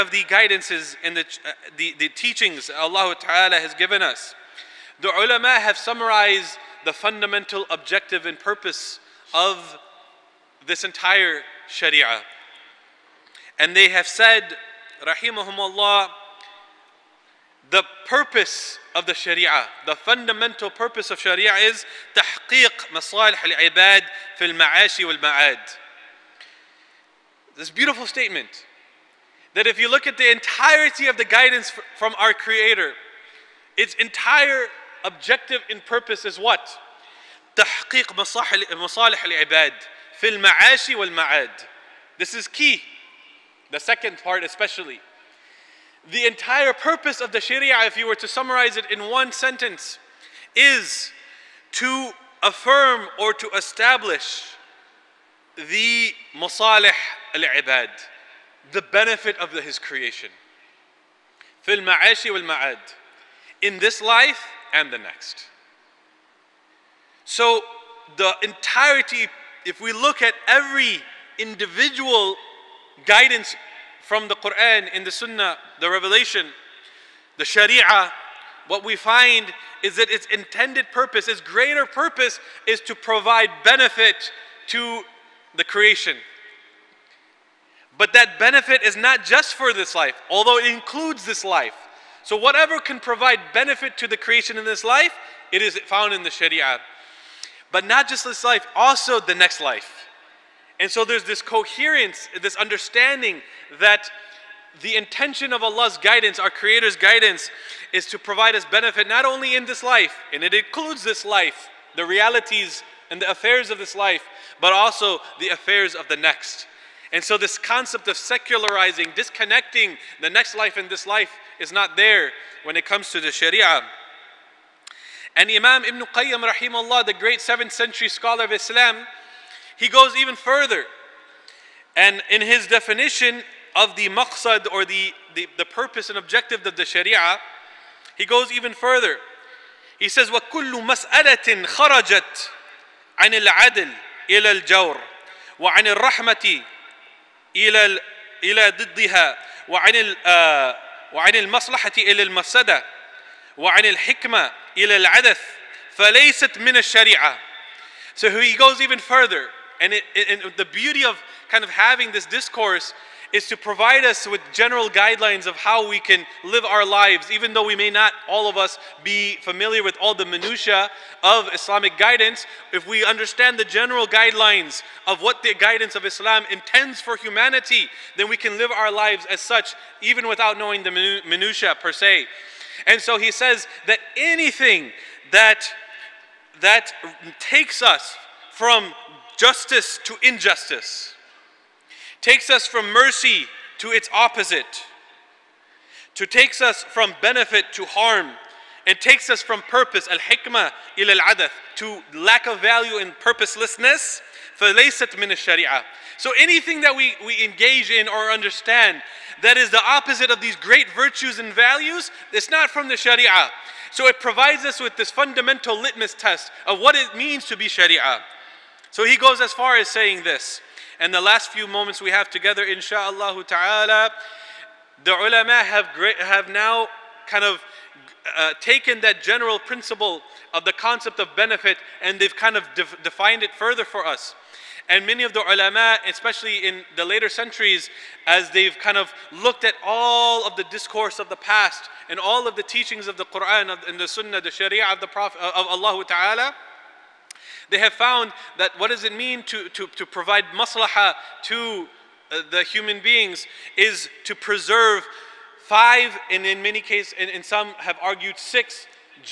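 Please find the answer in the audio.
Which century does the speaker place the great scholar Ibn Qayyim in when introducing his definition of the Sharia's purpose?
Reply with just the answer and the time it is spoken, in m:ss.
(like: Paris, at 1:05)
7th century, at 2:07.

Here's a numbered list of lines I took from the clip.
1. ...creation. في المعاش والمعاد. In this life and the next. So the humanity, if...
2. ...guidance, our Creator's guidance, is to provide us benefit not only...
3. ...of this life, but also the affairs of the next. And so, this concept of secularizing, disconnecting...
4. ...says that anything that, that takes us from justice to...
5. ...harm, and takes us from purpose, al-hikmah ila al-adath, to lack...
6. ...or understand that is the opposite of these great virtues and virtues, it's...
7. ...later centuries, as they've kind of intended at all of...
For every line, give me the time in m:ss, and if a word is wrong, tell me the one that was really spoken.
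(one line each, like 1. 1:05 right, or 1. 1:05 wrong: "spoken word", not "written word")
1. 0:59 wrong: "entirety", not "humanity"
2. 1:45 right
3. 1:53 right
4. 3:03 right
5. 3:17 right
6. 3:28 wrong: "values", not "virtues"
7. 3:57 wrong: "looked", not "intended".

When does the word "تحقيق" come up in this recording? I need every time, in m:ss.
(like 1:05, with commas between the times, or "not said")
0:22, 0:37.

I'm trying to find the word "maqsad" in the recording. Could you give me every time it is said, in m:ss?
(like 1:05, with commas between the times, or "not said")
2:14.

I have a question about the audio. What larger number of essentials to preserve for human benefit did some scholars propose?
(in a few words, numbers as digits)
6.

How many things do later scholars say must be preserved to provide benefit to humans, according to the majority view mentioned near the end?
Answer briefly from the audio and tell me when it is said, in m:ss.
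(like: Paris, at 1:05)
5, at 4:15.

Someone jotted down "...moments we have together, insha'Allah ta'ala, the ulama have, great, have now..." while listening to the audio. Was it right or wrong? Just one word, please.
right.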